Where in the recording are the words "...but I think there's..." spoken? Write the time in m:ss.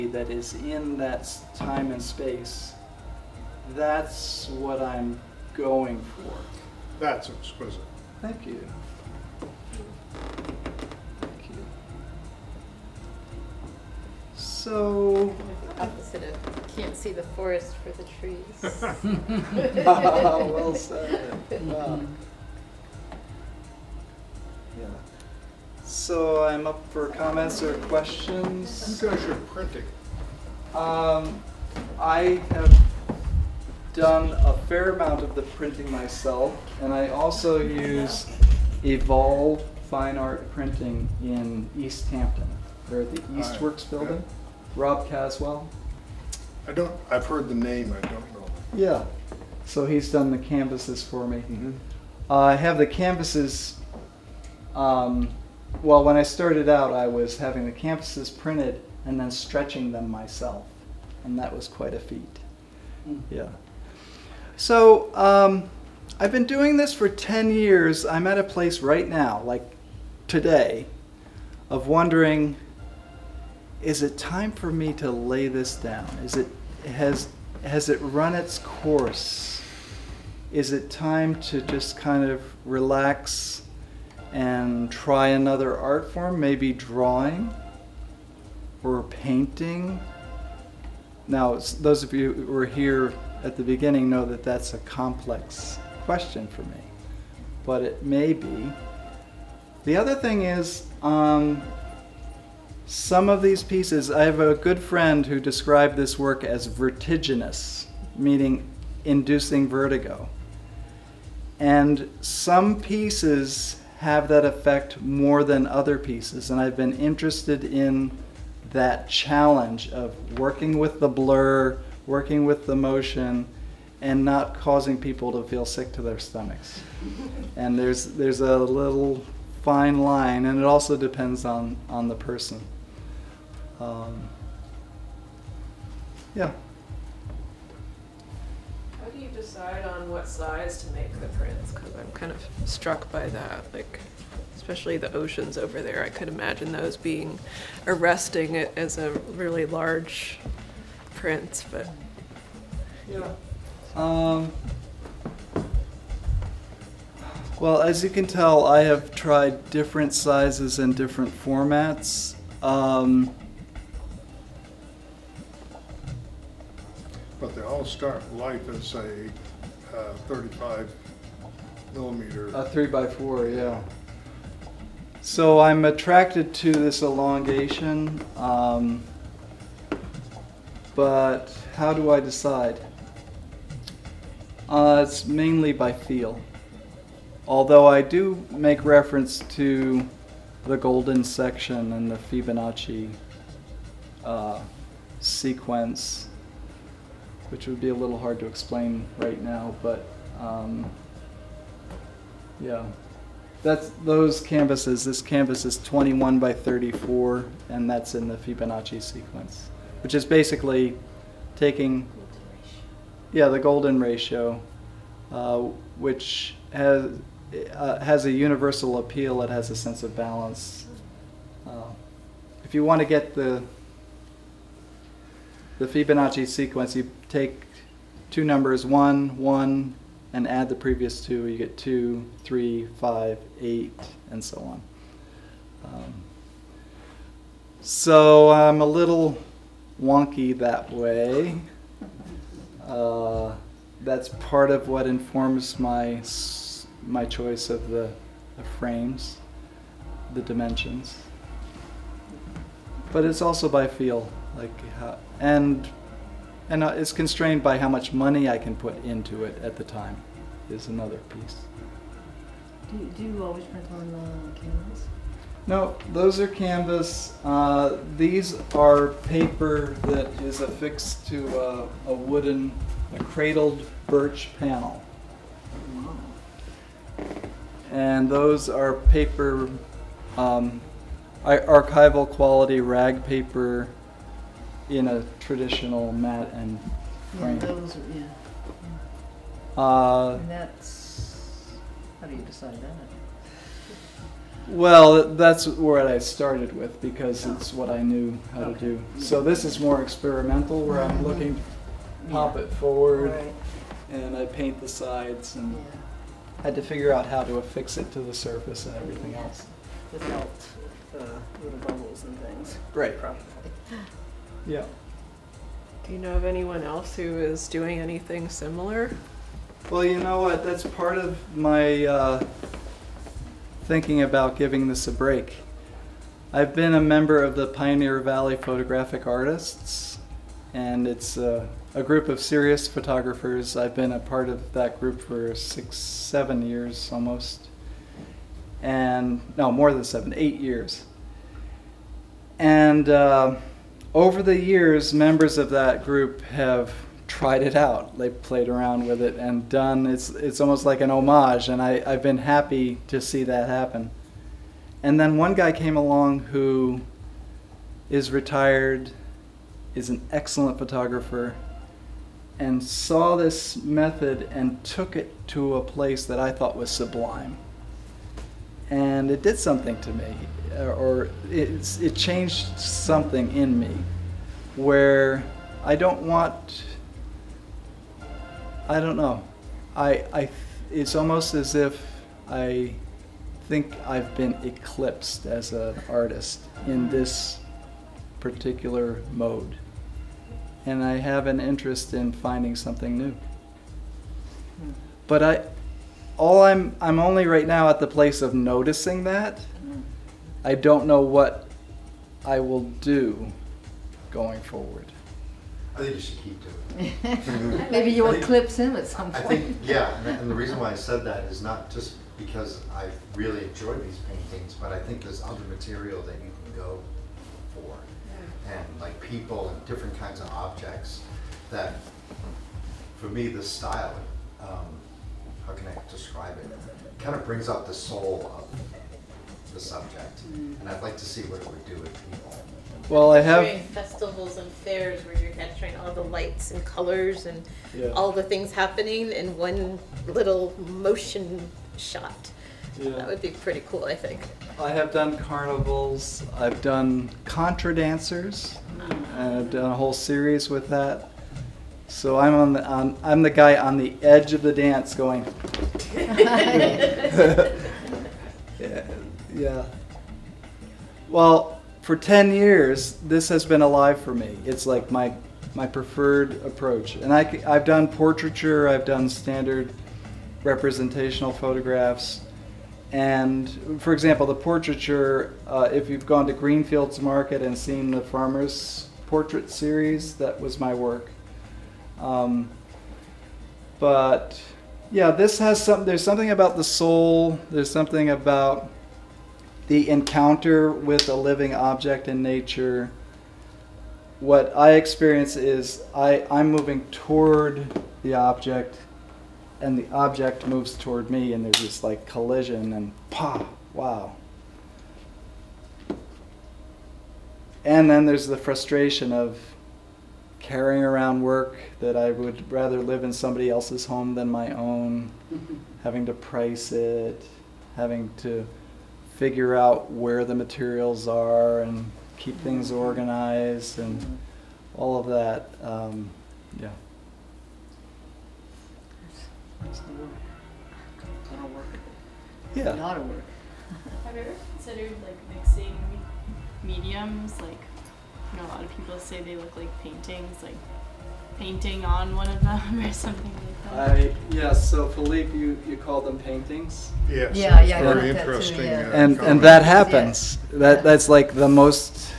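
6:54.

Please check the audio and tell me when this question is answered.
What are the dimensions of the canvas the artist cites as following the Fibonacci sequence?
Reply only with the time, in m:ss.
3:25.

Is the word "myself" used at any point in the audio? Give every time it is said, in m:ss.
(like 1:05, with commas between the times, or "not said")
0:35, 1:00.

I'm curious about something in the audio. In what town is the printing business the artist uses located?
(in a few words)
Easthampton.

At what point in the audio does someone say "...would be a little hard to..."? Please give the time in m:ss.
3:17.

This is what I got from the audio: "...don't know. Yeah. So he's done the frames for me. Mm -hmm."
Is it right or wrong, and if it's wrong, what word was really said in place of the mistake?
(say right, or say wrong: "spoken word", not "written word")
wrong: "canvases", not "frames".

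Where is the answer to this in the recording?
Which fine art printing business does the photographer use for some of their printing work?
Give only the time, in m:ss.
0:38.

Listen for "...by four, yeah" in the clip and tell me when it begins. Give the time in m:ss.
2:52.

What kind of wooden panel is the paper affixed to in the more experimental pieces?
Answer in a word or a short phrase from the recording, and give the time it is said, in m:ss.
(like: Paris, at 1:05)
cradled birch panel, at 4:33.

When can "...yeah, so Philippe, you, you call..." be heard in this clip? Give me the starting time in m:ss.
9:04.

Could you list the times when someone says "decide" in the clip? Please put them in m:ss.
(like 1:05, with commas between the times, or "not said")
2:19, 3:02, 4:52.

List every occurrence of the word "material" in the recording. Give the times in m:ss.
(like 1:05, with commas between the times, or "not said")
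6:55, 8:40.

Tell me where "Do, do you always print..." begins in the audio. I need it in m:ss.
4:22.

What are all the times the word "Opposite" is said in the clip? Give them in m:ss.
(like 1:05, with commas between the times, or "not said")
0:15.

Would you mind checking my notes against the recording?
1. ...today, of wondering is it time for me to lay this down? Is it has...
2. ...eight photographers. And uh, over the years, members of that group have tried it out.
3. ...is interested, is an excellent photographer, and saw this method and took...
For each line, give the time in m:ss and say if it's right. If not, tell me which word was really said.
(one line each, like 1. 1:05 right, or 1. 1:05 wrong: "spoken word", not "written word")
1. 1:10 right
2. 5:40 wrong: "years", not "photographers"
3. 5:58 wrong: "retired", not "interested".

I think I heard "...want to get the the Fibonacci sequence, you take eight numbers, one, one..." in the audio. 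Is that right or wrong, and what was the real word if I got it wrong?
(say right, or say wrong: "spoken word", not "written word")
wrong: "two", not "eight".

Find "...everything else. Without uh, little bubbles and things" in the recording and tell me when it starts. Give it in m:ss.
5:08.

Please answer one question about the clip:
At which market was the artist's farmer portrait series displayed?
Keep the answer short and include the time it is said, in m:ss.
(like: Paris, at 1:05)
Green Fields Market, at 7:56.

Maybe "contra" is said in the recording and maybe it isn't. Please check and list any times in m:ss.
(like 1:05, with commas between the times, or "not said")
7:27.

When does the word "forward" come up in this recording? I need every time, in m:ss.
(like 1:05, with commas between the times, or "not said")
5:02, 6:44.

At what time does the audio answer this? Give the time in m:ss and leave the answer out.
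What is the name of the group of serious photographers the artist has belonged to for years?
5:27.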